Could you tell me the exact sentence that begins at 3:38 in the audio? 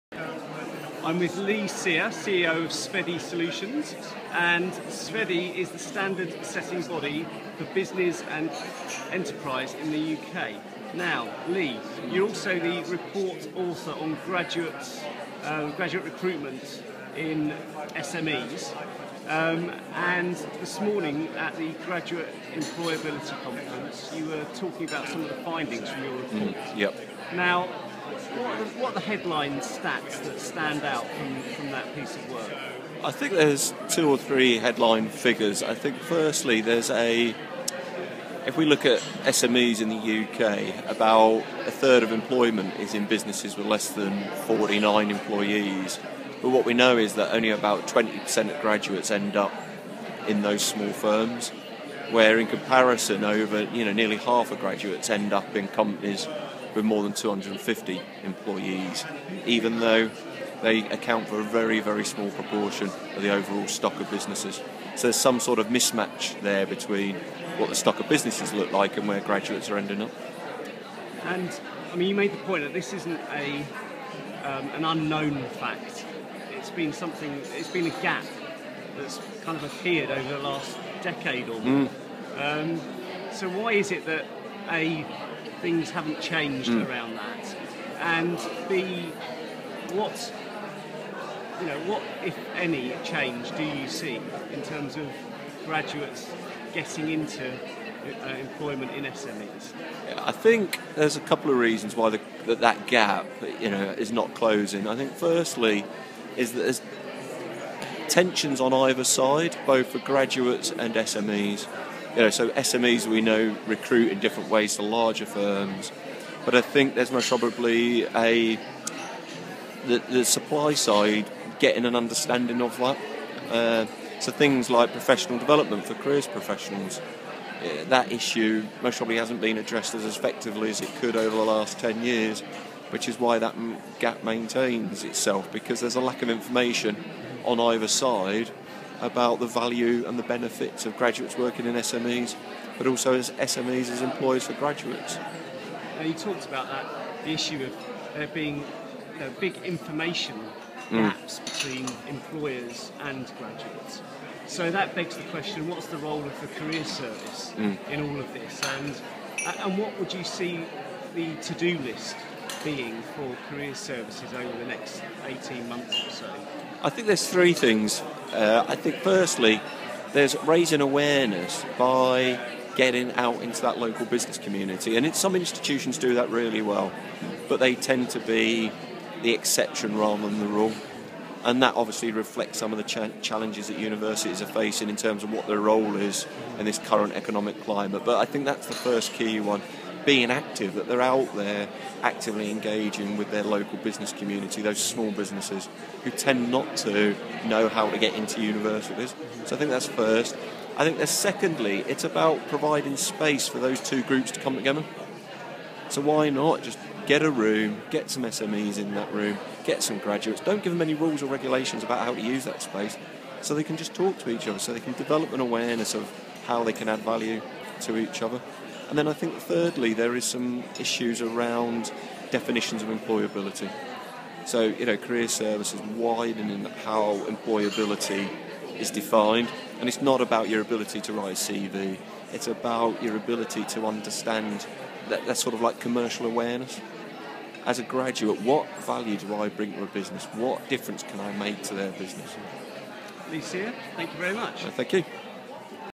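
And then I think thirdly, there is some issues around definitions of employability.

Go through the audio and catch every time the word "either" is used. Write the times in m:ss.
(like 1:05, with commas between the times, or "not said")
1:48, 2:17.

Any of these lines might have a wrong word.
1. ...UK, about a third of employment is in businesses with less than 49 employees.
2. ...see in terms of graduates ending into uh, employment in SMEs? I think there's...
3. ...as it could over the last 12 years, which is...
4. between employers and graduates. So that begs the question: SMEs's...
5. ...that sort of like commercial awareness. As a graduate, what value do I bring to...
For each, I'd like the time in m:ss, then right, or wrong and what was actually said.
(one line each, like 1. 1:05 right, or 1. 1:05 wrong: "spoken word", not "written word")
1. 0:40 right
2. 1:33 wrong: "getting", not "ending"
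3. 2:10 wrong: "10", not "12"
4. 2:31 wrong: "What", not "SMEs"
5. 3:55 right.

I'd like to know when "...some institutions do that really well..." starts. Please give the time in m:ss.
2:55.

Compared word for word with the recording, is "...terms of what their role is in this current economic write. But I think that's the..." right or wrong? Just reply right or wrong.
wrong.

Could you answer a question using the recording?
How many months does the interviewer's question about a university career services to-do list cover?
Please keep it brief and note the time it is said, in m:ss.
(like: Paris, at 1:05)
18, at 2:44.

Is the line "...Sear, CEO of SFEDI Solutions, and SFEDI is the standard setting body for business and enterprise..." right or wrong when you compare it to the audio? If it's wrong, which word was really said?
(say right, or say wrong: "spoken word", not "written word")
right.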